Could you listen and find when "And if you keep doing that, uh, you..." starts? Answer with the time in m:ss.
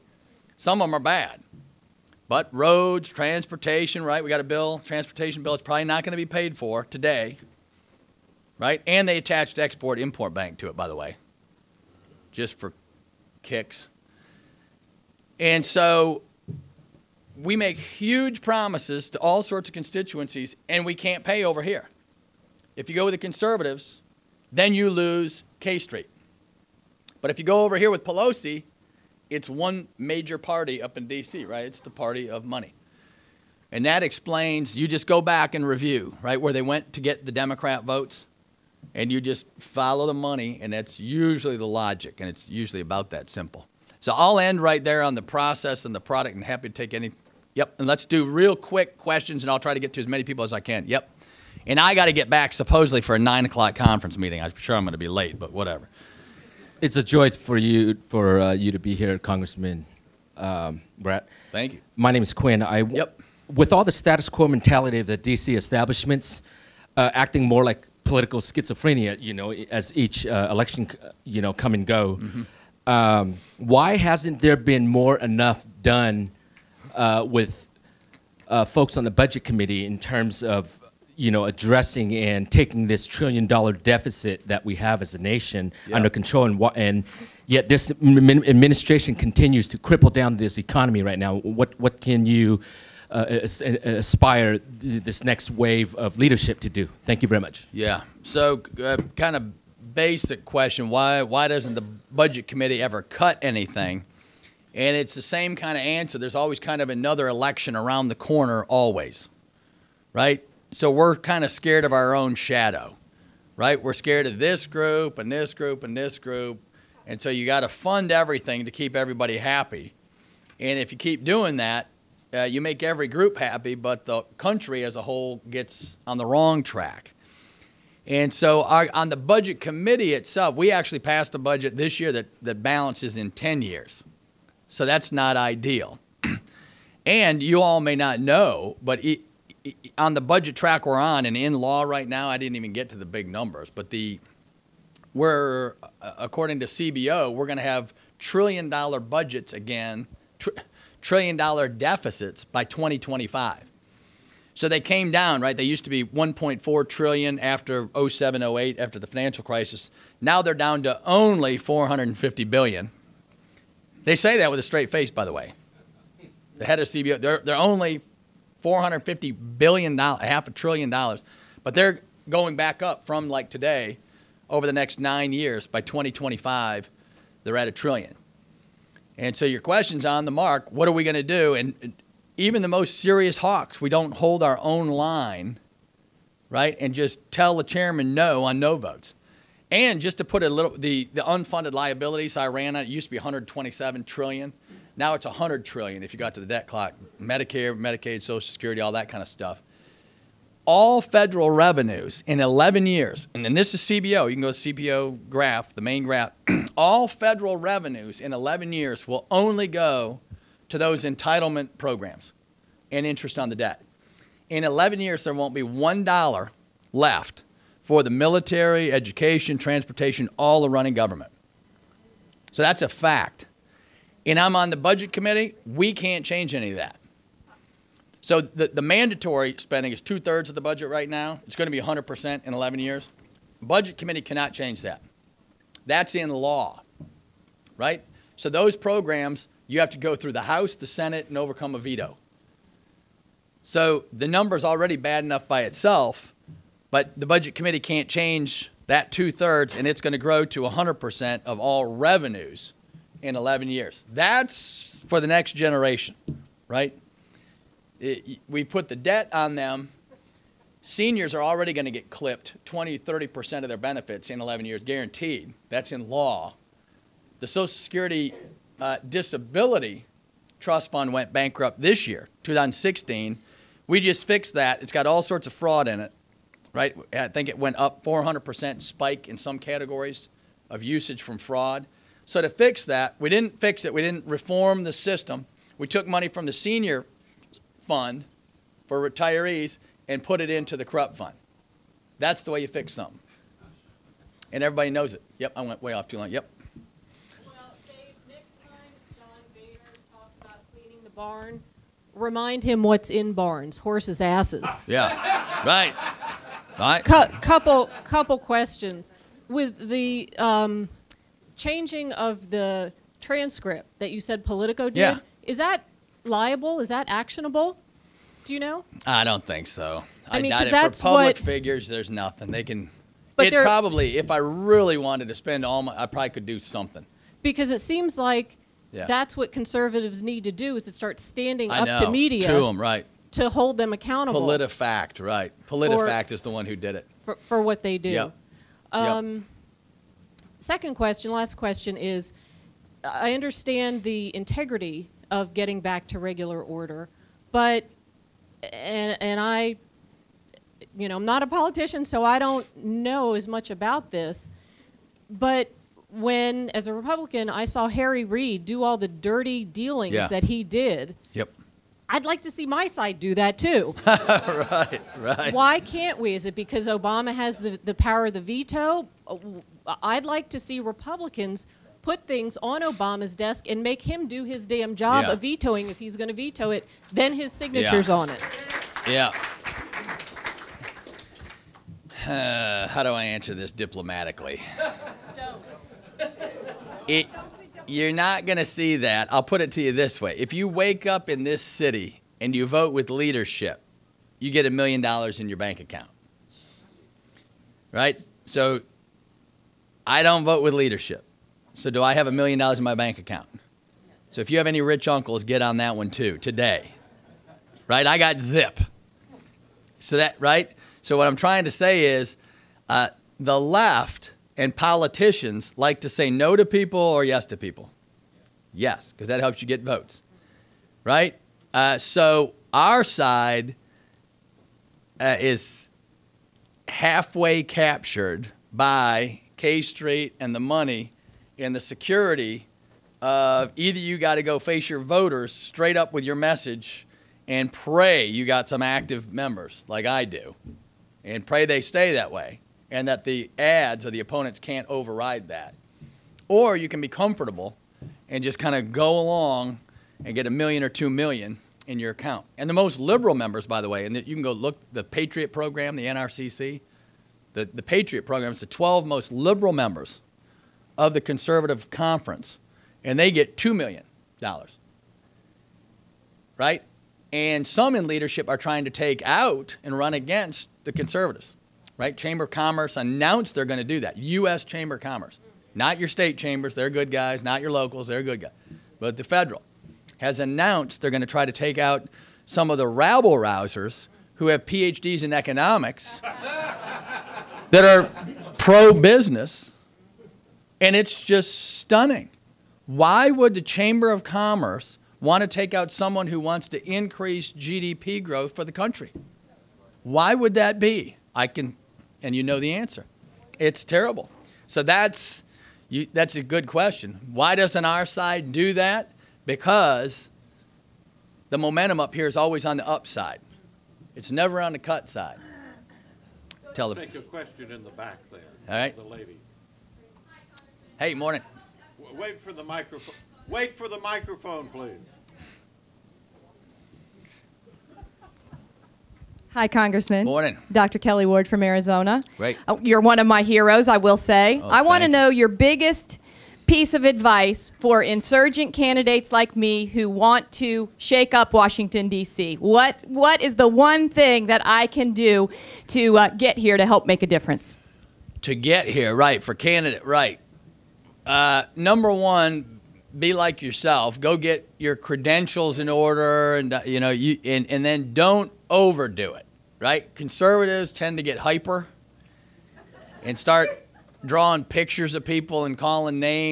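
2:00.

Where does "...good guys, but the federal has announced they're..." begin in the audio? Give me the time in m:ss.
7:58.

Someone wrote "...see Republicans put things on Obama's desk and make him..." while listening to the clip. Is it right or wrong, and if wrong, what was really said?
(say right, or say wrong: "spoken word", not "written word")
right.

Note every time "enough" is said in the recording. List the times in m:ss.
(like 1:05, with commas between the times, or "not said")
1:15, 4:05.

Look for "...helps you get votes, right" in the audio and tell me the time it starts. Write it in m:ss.
6:59.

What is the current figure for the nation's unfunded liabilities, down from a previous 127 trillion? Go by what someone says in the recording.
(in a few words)
100 trillion.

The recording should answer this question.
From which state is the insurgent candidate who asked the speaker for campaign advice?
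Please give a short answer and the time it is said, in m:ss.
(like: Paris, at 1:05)
Arizona, at 8:51.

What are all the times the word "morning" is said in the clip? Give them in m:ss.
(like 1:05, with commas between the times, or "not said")
8:41, 8:50.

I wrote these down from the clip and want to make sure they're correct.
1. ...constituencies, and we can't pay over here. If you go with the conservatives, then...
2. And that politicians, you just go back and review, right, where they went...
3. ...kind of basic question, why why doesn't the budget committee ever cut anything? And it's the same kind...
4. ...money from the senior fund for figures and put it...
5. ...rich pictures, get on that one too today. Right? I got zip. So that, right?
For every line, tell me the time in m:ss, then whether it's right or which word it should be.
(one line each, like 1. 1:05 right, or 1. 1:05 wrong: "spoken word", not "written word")
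1. 0:19 right
2. 0:33 wrong: "explains", not "politicians"
3. 1:39 right
4. 4:46 wrong: "retirees", not "figures"
5. 6:44 wrong: "uncles", not "pictures".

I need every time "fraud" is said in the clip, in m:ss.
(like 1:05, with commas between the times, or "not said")
4:35, 4:41.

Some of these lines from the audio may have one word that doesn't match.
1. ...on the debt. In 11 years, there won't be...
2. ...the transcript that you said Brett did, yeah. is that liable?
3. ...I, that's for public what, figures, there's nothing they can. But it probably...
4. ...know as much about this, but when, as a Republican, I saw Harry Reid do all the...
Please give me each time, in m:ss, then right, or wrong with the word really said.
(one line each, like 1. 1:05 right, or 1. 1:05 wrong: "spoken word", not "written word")
1. 3:33 right
2. 5:12 wrong: "Politico", not "Brett"
3. 5:20 right
4. 5:52 right.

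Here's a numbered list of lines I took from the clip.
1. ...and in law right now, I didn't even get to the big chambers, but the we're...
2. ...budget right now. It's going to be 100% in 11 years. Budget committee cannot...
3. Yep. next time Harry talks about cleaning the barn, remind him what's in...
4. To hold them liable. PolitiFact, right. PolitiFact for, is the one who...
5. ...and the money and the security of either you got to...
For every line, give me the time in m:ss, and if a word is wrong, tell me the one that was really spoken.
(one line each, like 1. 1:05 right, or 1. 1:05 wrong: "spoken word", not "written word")
1. 2:21 wrong: "numbers", not "chambers"
2. 3:50 right
3. 4:56 wrong: "John", not "Harry"
4. 5:33 wrong: "accountable", not "liable"
5. 7:10 right.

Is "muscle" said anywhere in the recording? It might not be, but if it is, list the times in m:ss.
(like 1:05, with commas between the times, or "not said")
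not said.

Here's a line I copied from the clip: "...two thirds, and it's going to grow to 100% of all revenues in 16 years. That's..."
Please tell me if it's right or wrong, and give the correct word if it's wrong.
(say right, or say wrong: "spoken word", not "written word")
wrong: "11", not "16".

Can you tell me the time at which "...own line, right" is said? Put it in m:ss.
3:04.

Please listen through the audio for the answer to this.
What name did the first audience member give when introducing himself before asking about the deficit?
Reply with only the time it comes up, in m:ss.
1:02.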